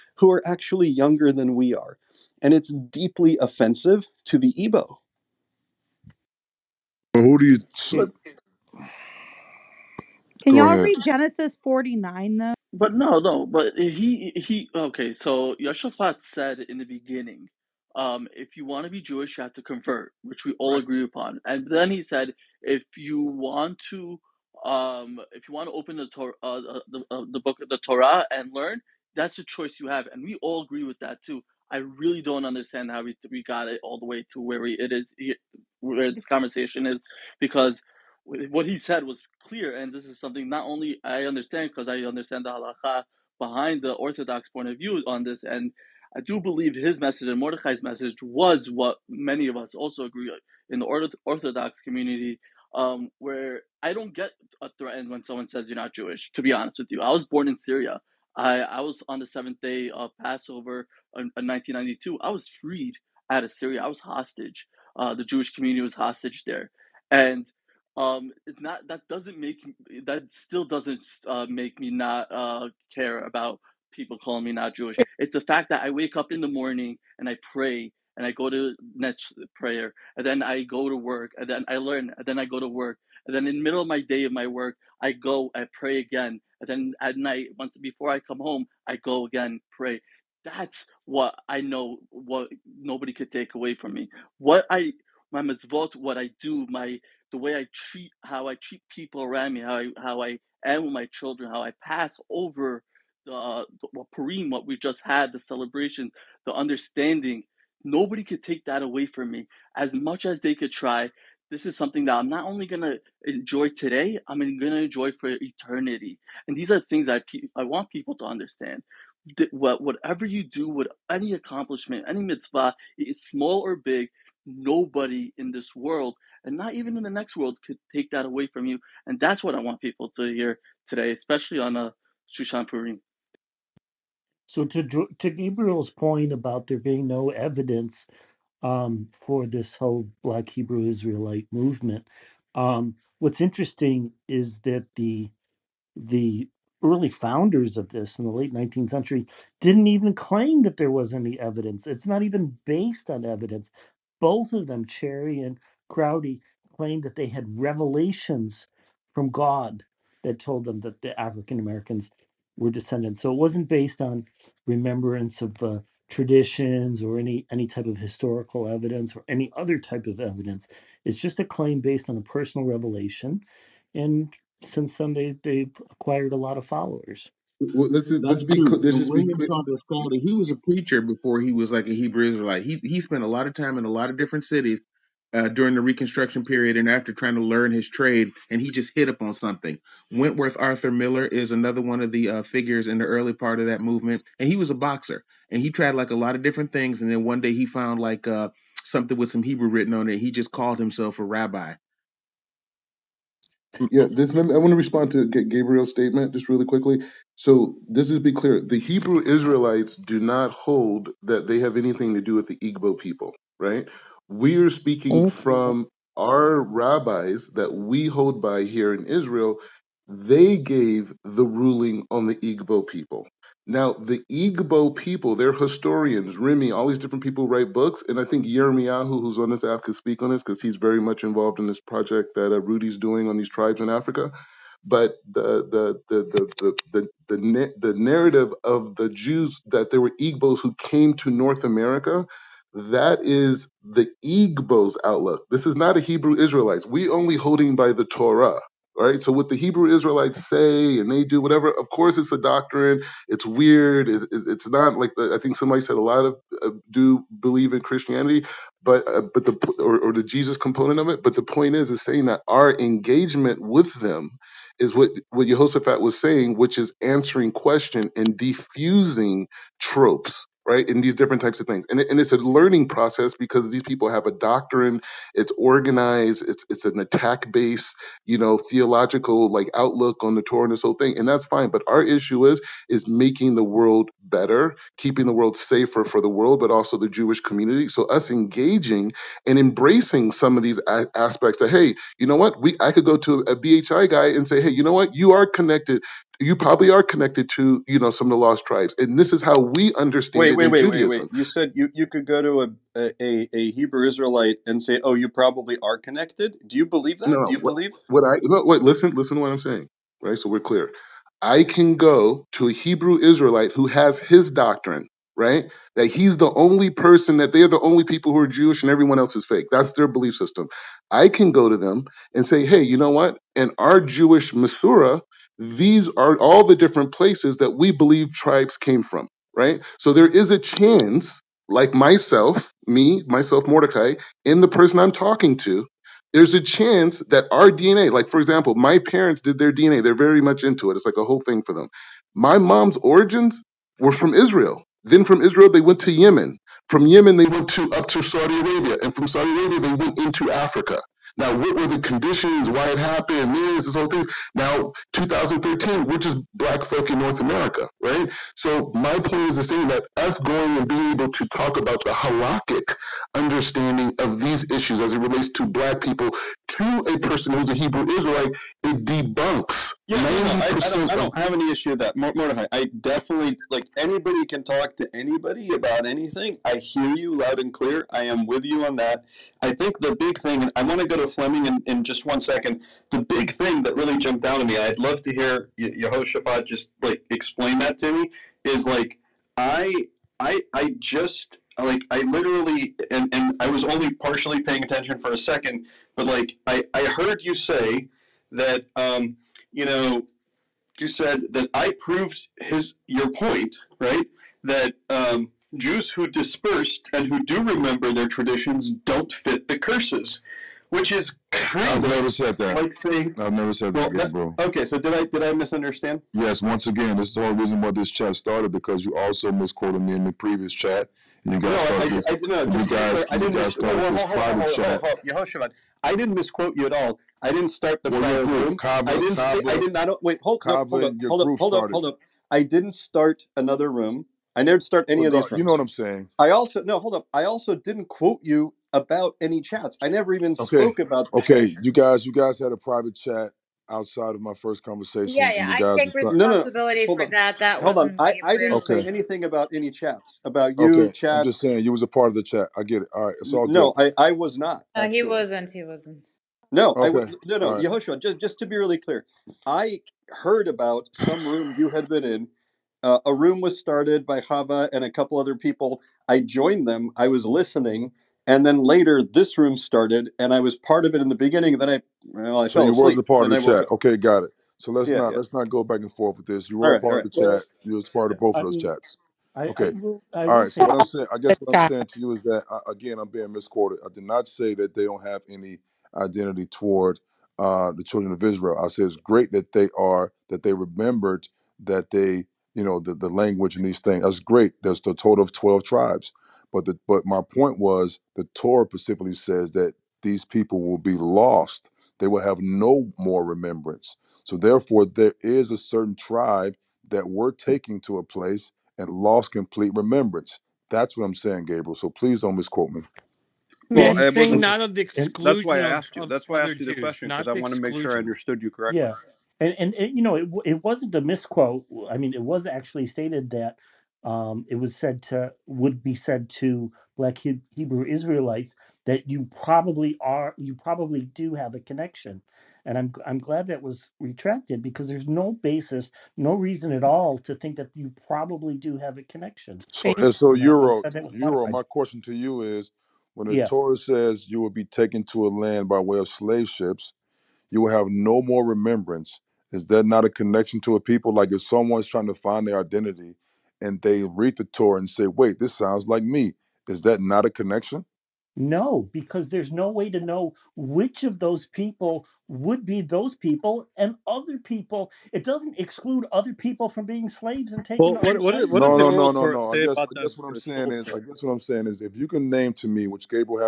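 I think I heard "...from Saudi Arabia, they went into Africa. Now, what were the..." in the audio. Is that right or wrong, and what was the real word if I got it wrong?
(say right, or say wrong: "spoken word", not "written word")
right.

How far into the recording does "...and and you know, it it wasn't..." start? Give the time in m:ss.
8:39.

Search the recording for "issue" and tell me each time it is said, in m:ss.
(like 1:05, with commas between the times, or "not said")
4:42, 6:04, 6:11.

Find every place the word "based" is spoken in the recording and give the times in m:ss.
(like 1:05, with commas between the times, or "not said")
2:32, 2:43, 2:51, 4:37.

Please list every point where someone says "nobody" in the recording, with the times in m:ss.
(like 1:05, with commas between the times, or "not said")
1:32, 1:47, 2:04.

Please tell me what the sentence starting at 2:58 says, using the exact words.
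cl- let's And just be clear.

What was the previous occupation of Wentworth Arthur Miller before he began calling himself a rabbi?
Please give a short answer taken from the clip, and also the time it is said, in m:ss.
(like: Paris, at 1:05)
boxer, at 3:14.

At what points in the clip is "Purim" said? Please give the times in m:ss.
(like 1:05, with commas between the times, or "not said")
1:44, 2:12.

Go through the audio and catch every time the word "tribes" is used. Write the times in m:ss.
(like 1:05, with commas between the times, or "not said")
3:53, 4:58, 5:28, 8:15, 8:26.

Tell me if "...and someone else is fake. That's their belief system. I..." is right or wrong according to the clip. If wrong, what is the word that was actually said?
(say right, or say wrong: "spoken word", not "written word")
wrong: "everyone", not "someone".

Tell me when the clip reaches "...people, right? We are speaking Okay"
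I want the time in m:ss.
3:32.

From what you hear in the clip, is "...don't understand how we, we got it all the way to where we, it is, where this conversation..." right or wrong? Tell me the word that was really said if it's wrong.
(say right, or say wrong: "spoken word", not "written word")
right.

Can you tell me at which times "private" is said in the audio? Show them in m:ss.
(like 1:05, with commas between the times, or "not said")
7:04, 7:22.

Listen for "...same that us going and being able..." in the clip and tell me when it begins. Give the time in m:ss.
5:59.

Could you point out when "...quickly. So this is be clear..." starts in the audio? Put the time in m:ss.
3:26.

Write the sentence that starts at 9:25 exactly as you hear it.
It doesn't exclude other people from being slaves and taking.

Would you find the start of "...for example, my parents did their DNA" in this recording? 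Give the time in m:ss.
5:38.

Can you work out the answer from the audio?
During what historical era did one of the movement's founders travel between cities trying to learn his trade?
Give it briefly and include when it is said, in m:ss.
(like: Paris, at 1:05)
Reconstruction period, at 3:05.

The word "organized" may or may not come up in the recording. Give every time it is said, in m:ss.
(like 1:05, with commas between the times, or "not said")
4:35.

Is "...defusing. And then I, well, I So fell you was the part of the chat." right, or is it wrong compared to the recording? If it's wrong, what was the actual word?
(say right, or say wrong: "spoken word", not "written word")
wrong: "beginning", not "defusing".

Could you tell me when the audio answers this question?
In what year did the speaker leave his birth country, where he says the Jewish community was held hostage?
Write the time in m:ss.
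1:01.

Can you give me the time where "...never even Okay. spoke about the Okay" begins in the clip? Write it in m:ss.
7:20.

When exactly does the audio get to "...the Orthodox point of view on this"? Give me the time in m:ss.
0:43.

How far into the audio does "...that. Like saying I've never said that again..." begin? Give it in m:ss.
6:52.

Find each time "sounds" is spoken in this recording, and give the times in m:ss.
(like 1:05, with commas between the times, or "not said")
9:15.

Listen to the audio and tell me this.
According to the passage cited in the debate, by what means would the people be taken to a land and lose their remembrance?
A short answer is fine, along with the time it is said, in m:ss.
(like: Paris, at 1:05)
slave ships, at 9:06.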